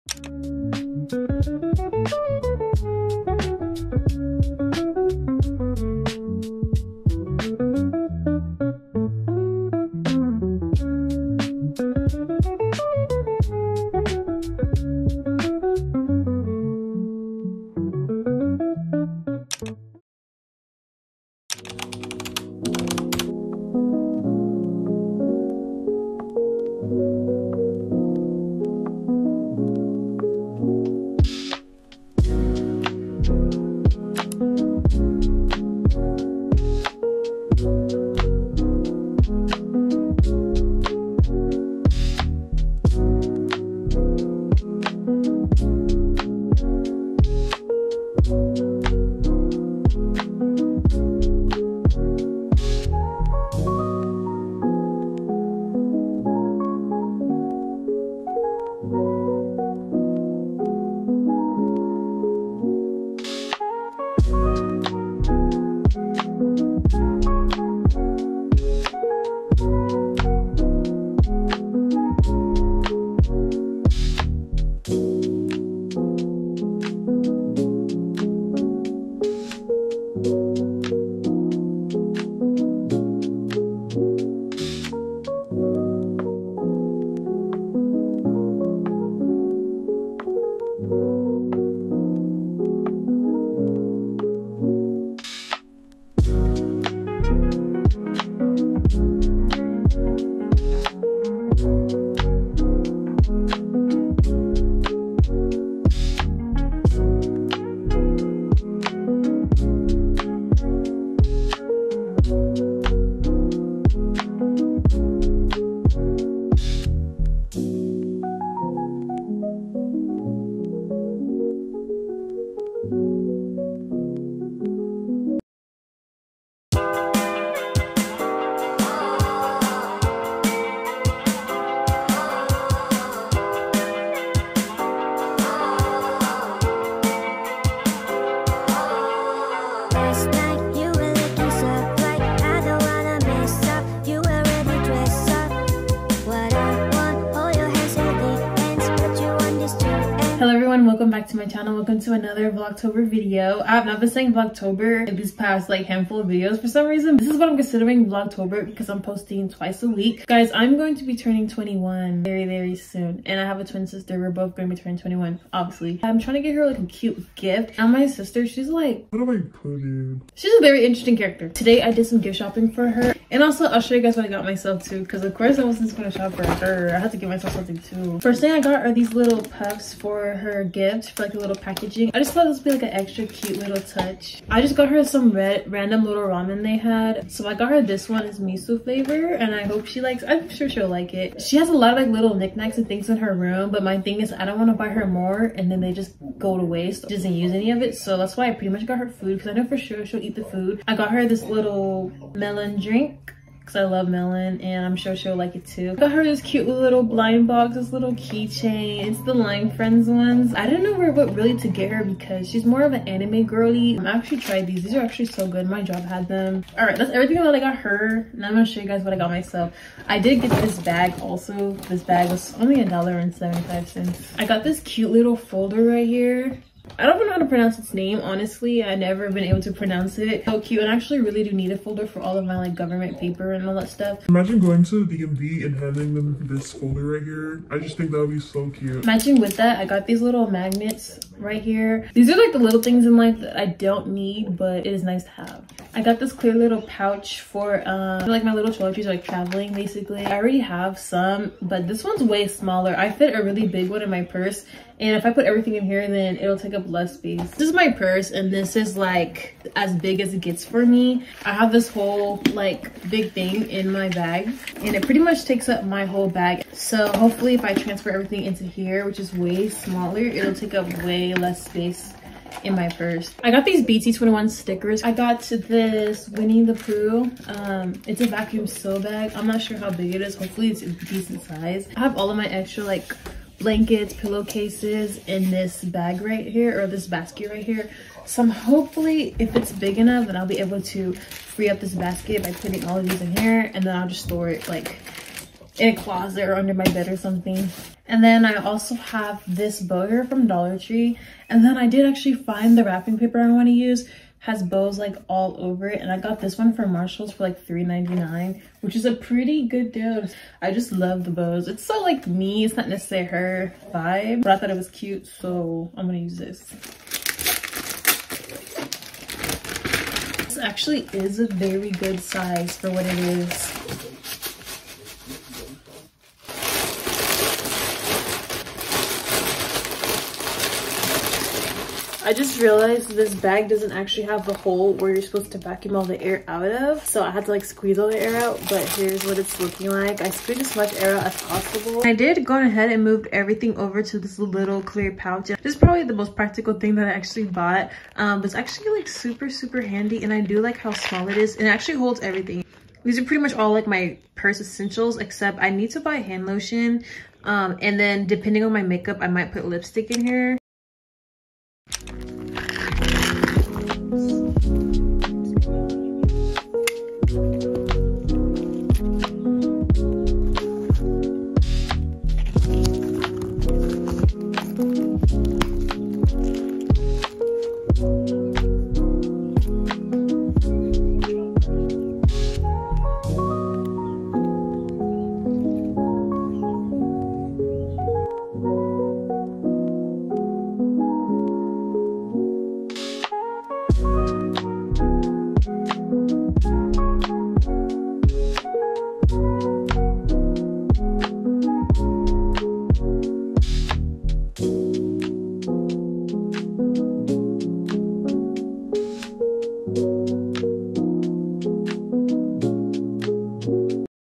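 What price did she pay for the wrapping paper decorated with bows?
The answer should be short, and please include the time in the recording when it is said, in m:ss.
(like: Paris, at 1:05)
$3.99, at 5:07.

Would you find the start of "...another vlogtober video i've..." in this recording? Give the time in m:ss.
2:32.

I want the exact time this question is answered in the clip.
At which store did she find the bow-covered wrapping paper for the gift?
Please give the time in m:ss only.
5:06.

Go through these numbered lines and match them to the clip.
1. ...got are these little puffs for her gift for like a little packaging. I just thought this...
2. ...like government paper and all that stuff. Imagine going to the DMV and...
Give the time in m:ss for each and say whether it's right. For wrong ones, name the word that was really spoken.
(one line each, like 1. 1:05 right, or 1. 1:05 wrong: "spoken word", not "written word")
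1. 2:58 right
2. 3:52 right.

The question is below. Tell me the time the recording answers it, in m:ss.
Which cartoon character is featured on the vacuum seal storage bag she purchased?
4:36.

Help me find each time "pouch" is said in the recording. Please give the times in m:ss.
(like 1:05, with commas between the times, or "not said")
4:06, 5:45.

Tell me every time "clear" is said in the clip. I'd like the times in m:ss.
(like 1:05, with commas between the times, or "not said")
4:06, 5:44.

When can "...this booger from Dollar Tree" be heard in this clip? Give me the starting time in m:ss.
4:59.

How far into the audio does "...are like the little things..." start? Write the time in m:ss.
4:02.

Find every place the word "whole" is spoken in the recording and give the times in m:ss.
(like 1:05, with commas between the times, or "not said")
4:21, 4:26.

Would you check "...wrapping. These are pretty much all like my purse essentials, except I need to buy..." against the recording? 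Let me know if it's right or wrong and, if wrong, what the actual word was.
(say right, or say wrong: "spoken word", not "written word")
wrong: "everything", not "wrapping".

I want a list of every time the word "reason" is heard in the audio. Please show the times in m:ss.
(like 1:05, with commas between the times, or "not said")
2:36.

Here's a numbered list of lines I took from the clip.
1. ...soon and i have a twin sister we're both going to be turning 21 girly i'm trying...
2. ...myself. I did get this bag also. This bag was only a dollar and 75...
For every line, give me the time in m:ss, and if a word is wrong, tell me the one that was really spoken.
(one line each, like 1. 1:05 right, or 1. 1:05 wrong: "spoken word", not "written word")
1. 2:42 wrong: "obviously", not "girly"
2. 3:39 right.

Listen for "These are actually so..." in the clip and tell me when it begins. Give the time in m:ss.
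3:34.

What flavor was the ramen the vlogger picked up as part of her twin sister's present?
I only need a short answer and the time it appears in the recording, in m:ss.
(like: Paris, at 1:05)
Miso, at 3:08.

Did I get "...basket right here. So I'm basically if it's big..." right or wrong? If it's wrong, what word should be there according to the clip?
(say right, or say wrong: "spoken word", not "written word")
wrong: "hopefully", not "basically".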